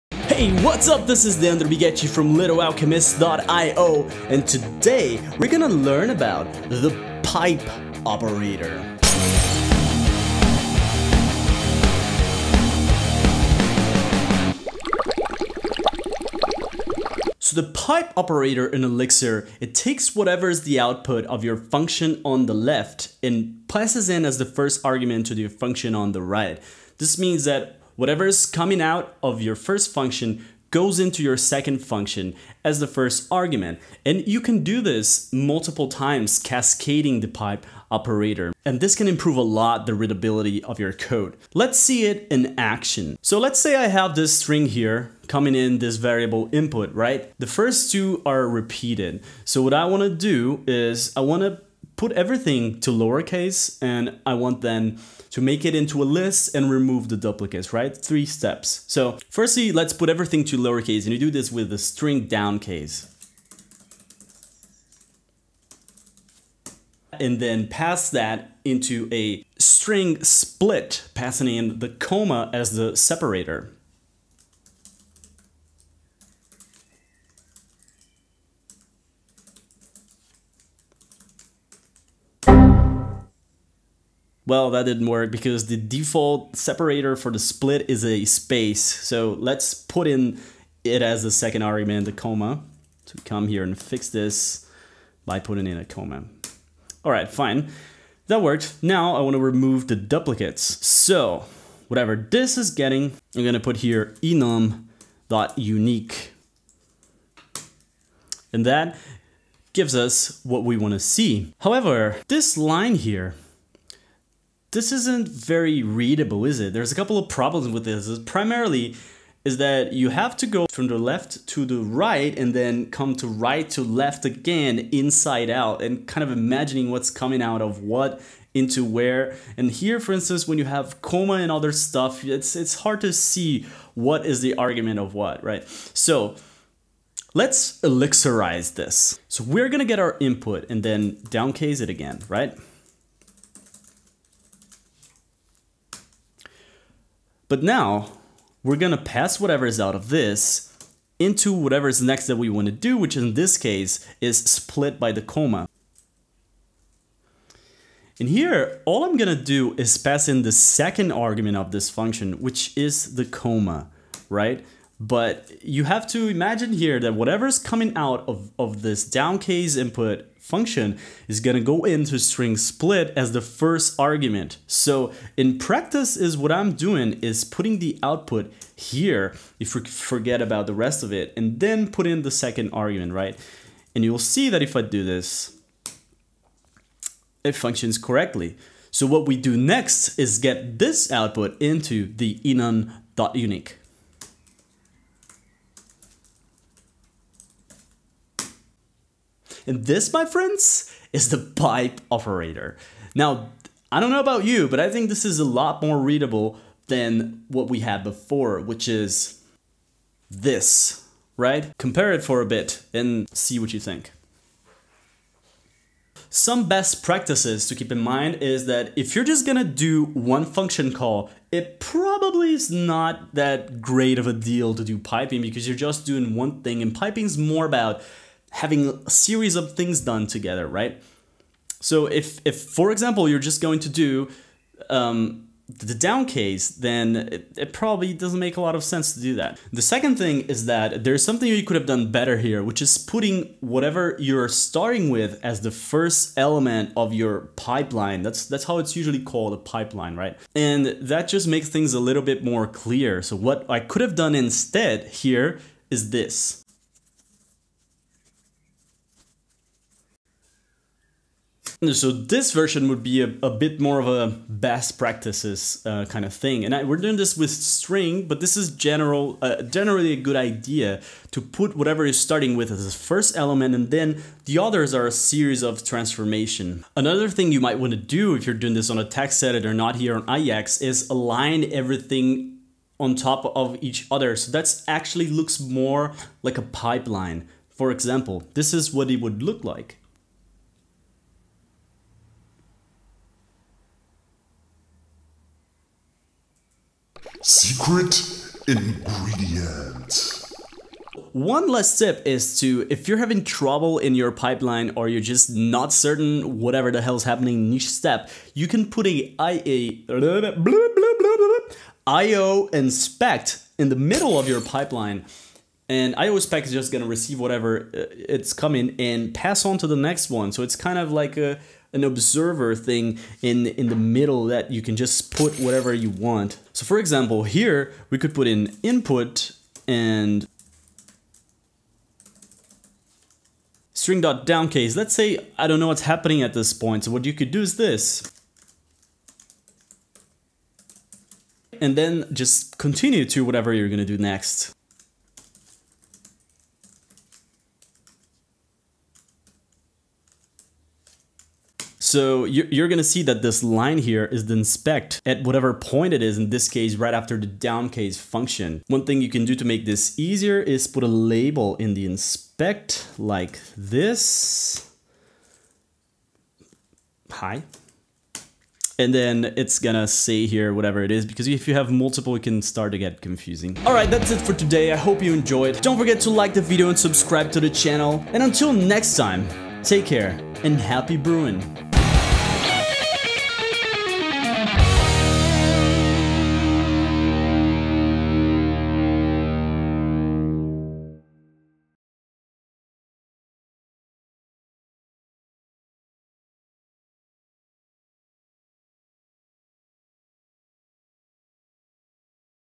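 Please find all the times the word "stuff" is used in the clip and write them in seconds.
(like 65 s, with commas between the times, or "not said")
131 s.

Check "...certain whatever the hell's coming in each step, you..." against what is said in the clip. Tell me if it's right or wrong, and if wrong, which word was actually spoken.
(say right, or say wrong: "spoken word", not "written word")
wrong: "happening", not "coming".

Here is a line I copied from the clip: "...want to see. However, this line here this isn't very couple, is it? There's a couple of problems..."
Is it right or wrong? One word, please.
wrong.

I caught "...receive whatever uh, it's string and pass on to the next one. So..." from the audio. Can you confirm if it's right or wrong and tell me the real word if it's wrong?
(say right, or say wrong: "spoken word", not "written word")
wrong: "coming", not "string".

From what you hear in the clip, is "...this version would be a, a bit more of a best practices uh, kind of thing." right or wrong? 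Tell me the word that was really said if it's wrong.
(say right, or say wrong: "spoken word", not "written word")
right.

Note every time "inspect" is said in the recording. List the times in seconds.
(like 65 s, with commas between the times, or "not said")
312 s, 354 s, 362 s.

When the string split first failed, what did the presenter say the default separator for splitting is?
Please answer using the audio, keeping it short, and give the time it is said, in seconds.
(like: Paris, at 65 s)
a space, at 88 s.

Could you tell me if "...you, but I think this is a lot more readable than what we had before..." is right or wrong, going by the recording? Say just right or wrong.
right.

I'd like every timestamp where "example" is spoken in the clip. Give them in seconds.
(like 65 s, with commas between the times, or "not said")
232 s, 287 s, 326 s.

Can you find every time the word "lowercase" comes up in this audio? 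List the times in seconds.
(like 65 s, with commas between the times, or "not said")
52 s, 60 s.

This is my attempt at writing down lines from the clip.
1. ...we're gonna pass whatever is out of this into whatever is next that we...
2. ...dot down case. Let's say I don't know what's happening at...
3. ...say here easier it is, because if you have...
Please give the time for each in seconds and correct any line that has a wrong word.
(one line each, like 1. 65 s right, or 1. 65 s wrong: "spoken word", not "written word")
1. 148 s right
2. 334 s right
3. 370 s wrong: "whatever", not "easier".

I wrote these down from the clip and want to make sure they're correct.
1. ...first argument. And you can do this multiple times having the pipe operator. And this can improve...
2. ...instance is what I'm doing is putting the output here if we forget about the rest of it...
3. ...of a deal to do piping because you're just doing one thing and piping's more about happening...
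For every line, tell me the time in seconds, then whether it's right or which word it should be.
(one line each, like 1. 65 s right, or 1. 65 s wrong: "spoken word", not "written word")
1. 32 s wrong: "cascading", not "having"
2. 175 s wrong: "practice", not "instance"
3. 224 s wrong: "having", not "happening".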